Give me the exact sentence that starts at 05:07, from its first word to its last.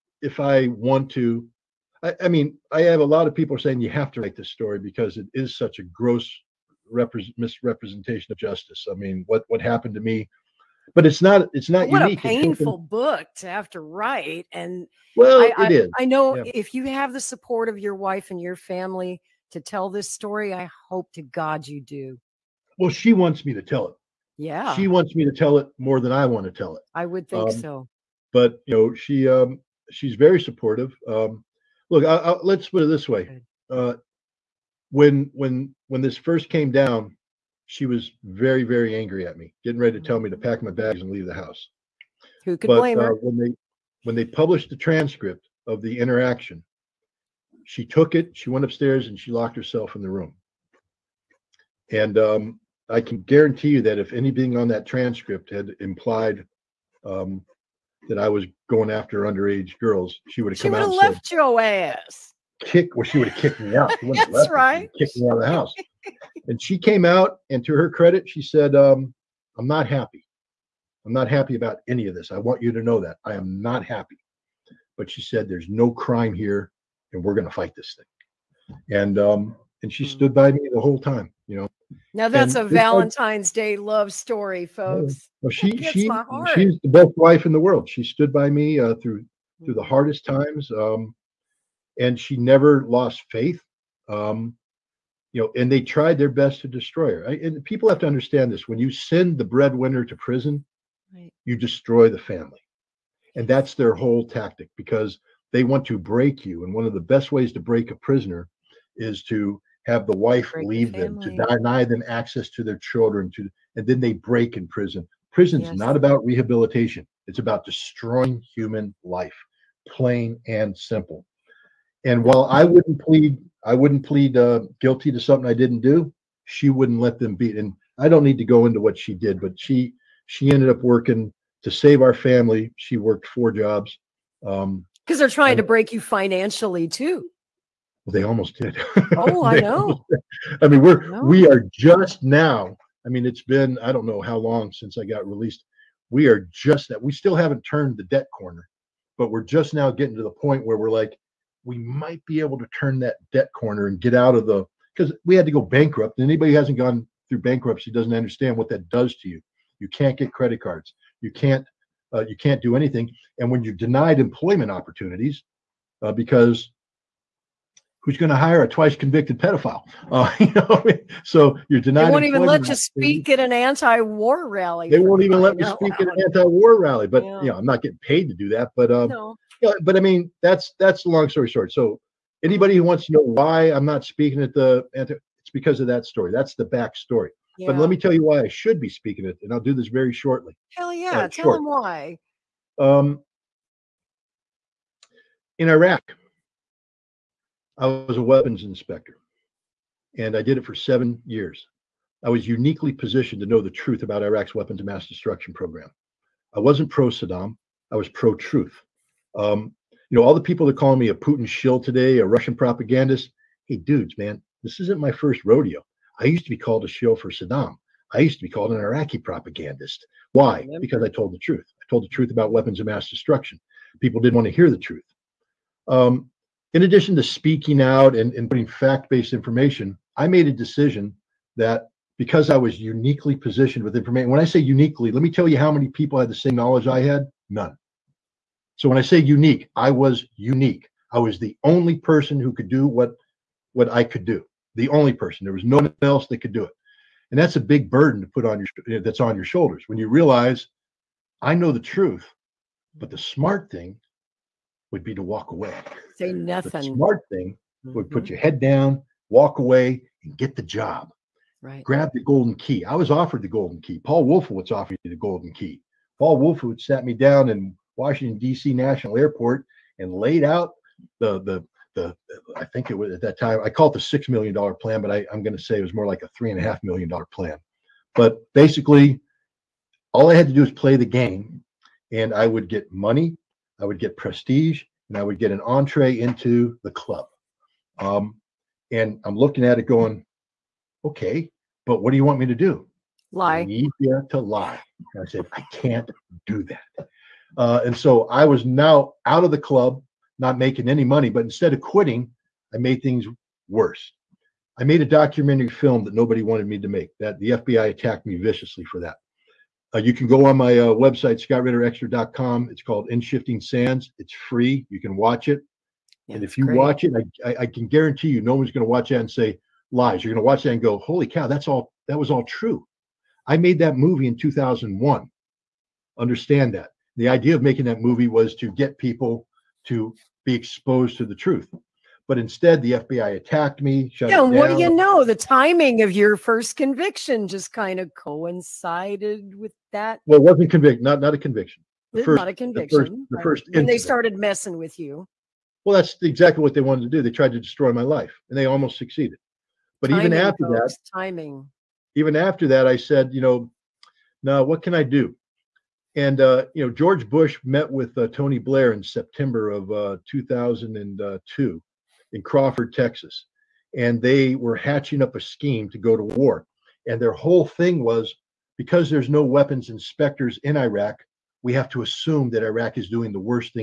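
That the FBI attacked me viciously for that.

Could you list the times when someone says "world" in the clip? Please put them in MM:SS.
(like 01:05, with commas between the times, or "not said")
01:27.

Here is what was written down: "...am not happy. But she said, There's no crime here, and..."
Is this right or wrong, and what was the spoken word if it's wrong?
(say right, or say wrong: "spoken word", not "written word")
right.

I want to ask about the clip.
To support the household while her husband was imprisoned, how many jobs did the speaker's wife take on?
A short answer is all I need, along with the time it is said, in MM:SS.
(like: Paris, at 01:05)
4, at 02:13.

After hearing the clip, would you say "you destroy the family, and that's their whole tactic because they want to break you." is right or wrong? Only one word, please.
right.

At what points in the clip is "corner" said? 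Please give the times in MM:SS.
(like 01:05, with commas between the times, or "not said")
02:28, 02:33.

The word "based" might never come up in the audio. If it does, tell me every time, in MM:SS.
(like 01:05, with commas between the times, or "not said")
03:49.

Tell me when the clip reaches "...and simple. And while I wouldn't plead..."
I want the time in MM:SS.
02:00.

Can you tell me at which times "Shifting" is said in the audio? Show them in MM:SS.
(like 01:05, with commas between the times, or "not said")
05:13.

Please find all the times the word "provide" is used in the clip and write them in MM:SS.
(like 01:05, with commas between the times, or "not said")
not said.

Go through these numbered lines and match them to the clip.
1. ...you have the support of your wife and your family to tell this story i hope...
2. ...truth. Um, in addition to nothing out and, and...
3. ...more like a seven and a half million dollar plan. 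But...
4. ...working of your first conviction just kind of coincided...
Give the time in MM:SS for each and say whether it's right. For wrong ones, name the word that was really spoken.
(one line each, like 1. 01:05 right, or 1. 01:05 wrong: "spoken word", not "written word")
1. 00:16 right
2. 03:44 wrong: "speaking", not "nothing"
3. 04:35 wrong: "three", not "seven"
4. 05:35 wrong: "timing", not "working".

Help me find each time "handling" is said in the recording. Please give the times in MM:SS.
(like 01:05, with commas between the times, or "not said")
not said.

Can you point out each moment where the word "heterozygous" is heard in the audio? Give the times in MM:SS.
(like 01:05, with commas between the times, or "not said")
not said.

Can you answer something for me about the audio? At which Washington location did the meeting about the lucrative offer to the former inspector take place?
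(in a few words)
Washington D.C. National Airport.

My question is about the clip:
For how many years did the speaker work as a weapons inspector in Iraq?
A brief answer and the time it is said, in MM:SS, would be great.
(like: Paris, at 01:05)
7, at 03:20.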